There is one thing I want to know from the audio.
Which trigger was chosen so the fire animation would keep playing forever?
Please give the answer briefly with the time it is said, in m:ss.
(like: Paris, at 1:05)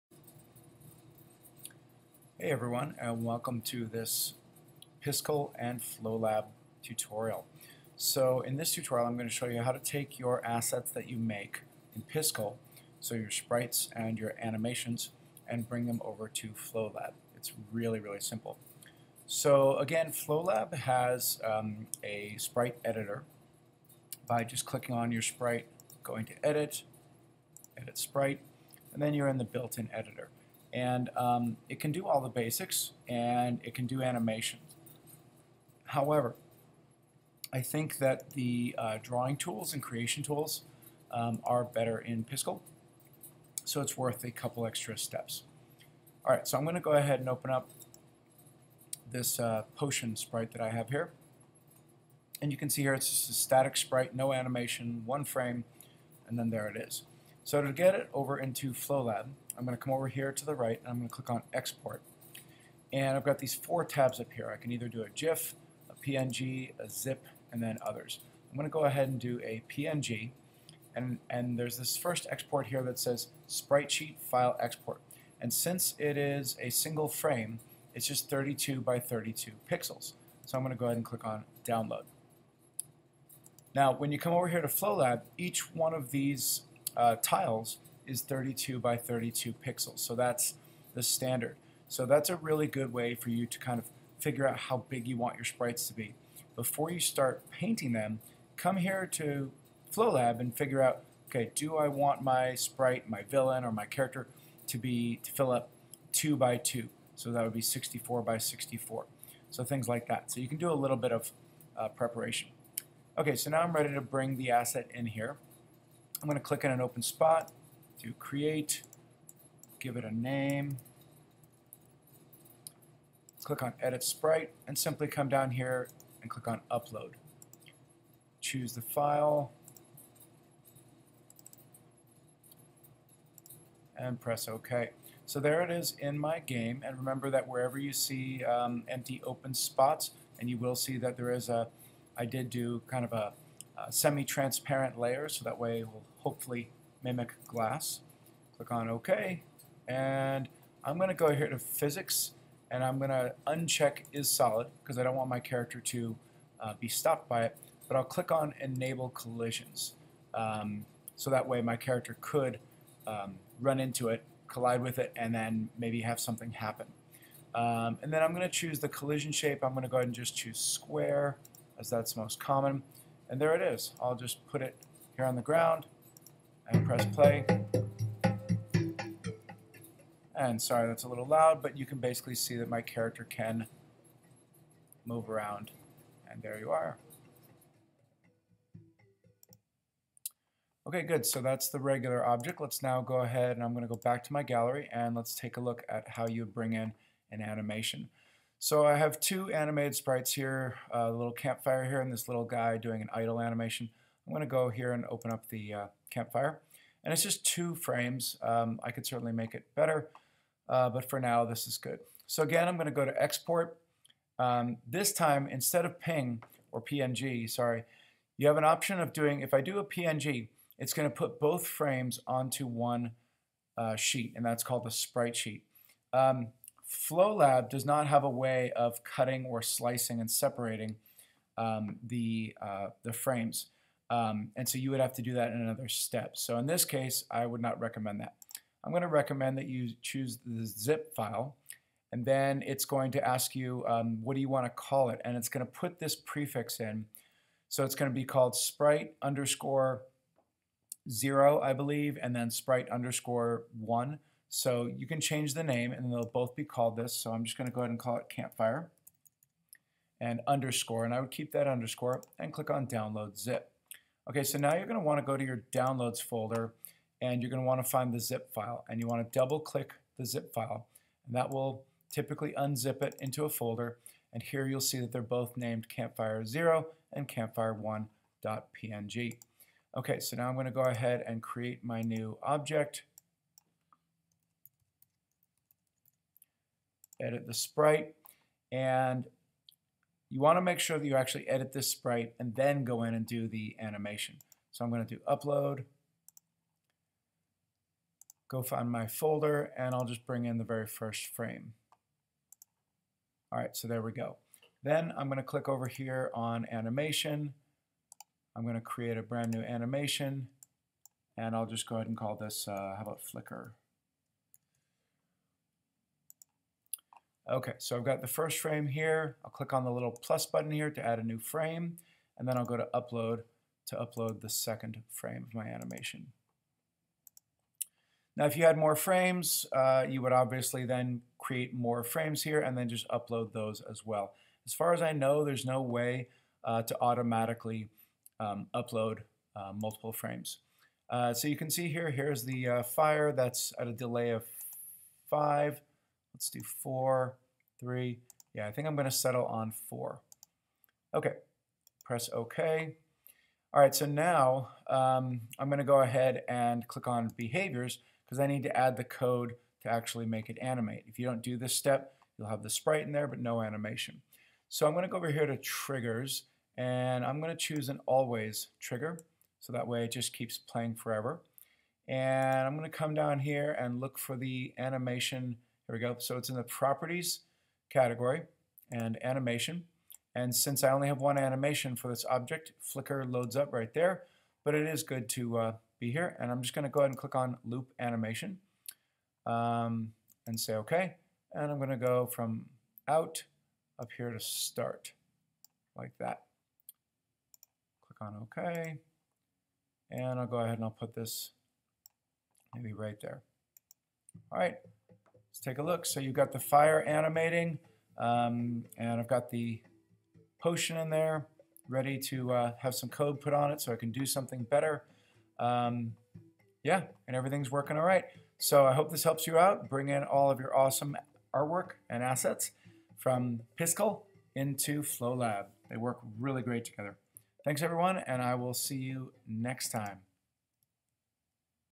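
Always, at 6:08.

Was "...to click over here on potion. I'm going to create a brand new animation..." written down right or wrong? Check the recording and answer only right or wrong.
wrong.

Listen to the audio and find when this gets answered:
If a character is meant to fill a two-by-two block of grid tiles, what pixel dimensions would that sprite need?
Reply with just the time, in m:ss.
1:47.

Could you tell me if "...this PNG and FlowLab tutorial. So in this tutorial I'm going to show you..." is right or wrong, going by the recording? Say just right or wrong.
wrong.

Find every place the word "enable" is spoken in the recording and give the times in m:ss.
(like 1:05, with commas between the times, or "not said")
2:38.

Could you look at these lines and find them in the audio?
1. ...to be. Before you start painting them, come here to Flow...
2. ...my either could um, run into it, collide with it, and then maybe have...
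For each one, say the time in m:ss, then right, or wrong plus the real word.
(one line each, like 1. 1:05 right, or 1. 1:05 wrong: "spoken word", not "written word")
1. 1:35 right
2. 2:41 wrong: "character", not "either".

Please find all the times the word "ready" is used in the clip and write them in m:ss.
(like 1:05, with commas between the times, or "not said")
1:53, 6:51.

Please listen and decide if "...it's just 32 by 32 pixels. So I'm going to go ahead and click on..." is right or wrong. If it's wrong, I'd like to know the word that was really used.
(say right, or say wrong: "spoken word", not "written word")
right.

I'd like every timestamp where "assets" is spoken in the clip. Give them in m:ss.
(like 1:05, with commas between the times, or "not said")
0:10, 1:54, 7:02.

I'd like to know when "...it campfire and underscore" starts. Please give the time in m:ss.
4:18.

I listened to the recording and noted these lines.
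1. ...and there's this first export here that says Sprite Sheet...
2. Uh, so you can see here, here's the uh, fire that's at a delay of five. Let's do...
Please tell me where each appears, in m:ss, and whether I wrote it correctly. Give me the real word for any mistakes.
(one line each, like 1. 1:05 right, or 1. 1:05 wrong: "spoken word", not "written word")
1. 1:11 right
2. 5:41 right.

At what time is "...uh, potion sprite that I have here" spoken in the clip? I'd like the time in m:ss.
0:49.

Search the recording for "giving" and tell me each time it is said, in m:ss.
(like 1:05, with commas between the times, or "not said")
not said.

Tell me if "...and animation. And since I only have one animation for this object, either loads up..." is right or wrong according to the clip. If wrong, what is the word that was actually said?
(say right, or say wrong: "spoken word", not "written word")
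wrong: "flicker", not "either".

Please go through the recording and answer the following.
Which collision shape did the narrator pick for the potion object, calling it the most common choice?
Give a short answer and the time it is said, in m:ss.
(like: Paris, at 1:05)
square, at 2:50.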